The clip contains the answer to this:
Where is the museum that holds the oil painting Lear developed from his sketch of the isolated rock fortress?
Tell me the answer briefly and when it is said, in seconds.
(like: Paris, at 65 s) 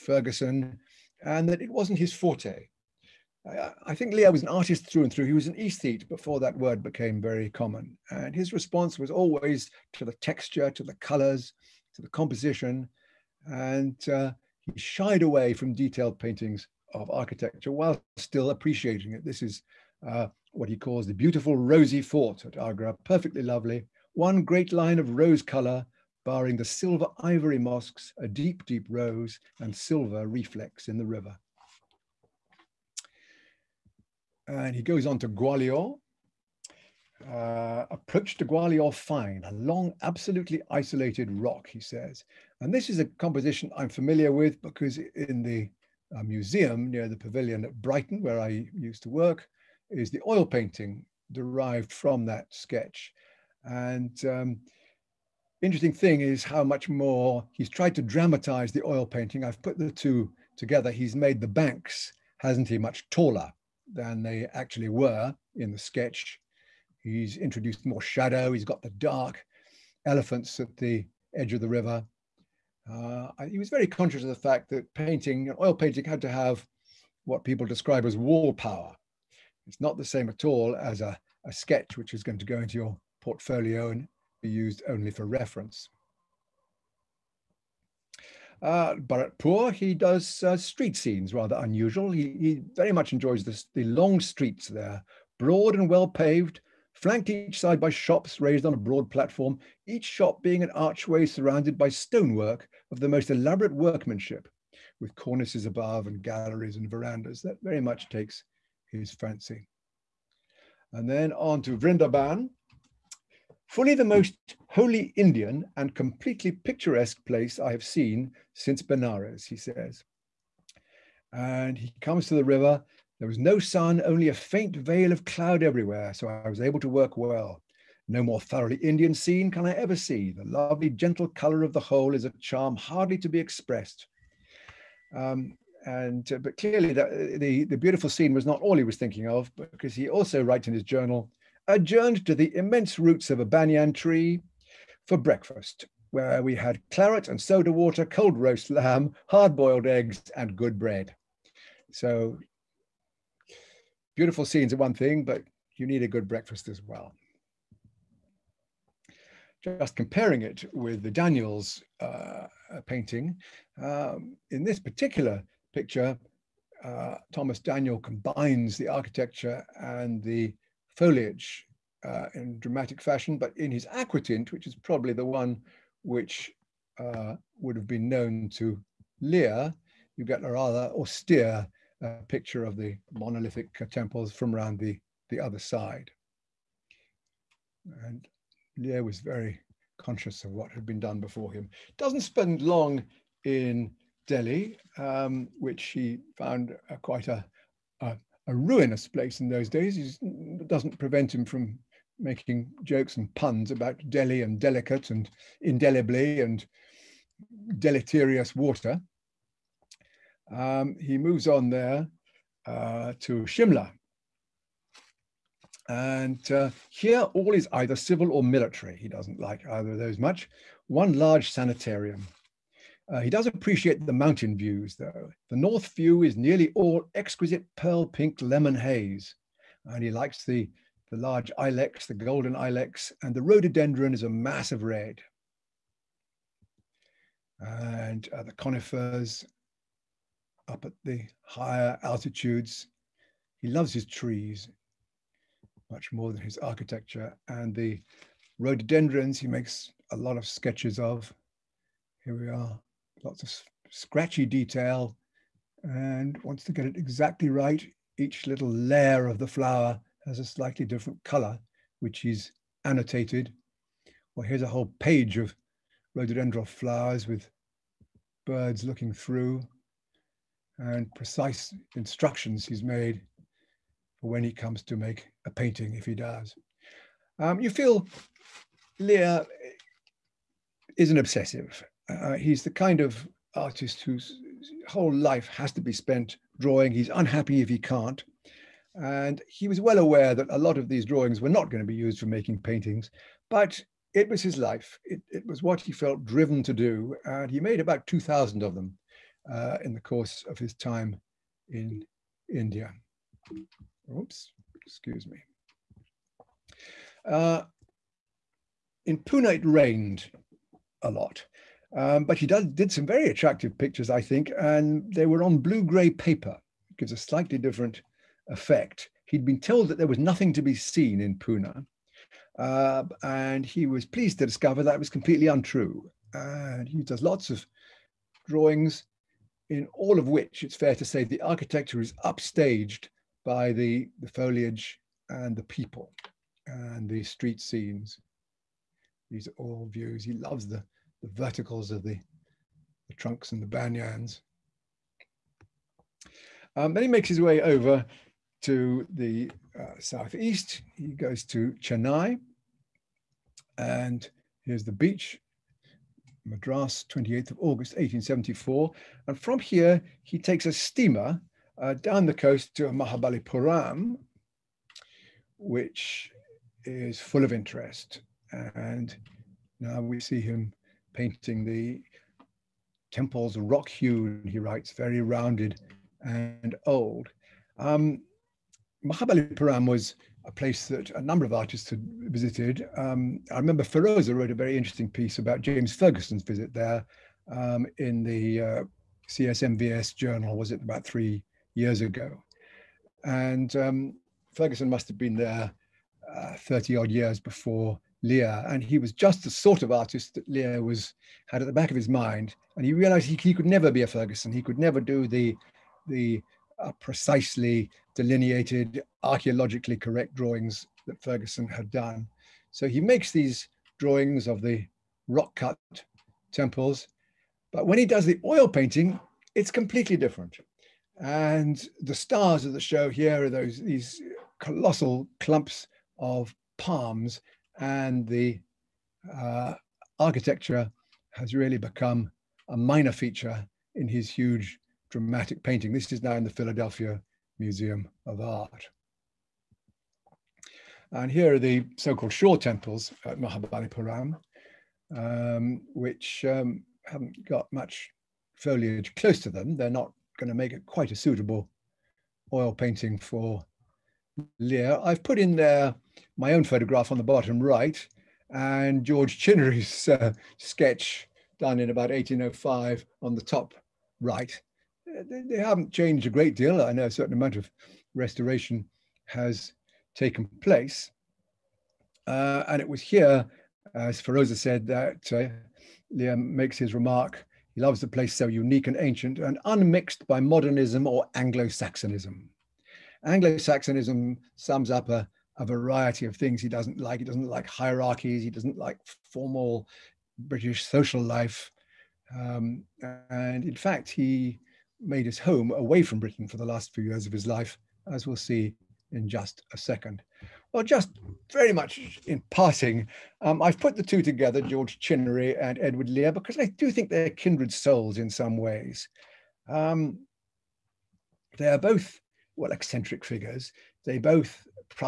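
Brighton, at 47 s.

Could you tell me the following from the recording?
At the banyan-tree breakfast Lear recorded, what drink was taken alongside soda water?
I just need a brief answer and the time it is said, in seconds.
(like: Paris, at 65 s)
Claret, at 146 s.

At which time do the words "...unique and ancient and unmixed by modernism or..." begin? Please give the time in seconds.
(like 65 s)
478 s.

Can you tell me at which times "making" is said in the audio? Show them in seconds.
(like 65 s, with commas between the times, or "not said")
202 s, 292 s.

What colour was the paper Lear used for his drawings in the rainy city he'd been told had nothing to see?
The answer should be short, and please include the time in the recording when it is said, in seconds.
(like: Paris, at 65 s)
Blue-gray, at 315 s.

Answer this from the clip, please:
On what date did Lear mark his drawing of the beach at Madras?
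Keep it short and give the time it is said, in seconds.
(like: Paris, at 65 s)
28 August 1874, at 357 s.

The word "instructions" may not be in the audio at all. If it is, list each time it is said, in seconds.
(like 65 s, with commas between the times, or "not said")
271 s.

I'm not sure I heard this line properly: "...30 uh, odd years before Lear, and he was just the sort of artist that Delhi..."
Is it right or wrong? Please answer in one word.
wrong.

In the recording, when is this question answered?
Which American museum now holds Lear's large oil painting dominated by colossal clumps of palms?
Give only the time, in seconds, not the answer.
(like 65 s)
436 s.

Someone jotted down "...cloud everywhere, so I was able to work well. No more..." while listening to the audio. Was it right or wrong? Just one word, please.
right.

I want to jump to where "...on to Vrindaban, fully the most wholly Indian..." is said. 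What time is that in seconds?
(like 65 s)
111 s.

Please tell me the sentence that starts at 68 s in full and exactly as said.
He's got the dark elephants at the edge of the river.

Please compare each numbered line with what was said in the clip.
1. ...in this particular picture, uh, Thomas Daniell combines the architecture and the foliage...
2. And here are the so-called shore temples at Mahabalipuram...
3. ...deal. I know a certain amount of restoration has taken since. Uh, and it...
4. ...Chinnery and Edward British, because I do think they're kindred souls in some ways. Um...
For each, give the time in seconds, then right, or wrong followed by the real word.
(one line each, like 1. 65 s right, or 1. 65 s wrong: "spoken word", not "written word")
1. 164 s right
2. 441 s right
3. 466 s wrong: "place", not "since"
4. 504 s wrong: "Lear", not "British".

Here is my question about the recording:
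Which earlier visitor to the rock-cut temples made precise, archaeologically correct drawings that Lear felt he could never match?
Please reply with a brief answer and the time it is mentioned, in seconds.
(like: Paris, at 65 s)
James Fergusson, at 385 s.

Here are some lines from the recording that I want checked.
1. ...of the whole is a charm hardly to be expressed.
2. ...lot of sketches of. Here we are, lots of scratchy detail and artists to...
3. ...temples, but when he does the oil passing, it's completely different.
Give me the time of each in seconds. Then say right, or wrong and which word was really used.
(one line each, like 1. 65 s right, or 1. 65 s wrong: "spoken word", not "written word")
1. 131 s right
2. 250 s wrong: "wants", not "artists"
3. 416 s wrong: "painting", not "passing".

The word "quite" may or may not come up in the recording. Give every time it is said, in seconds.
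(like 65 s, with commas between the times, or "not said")
197 s, 450 s.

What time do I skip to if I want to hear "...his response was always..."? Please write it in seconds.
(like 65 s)
8 s.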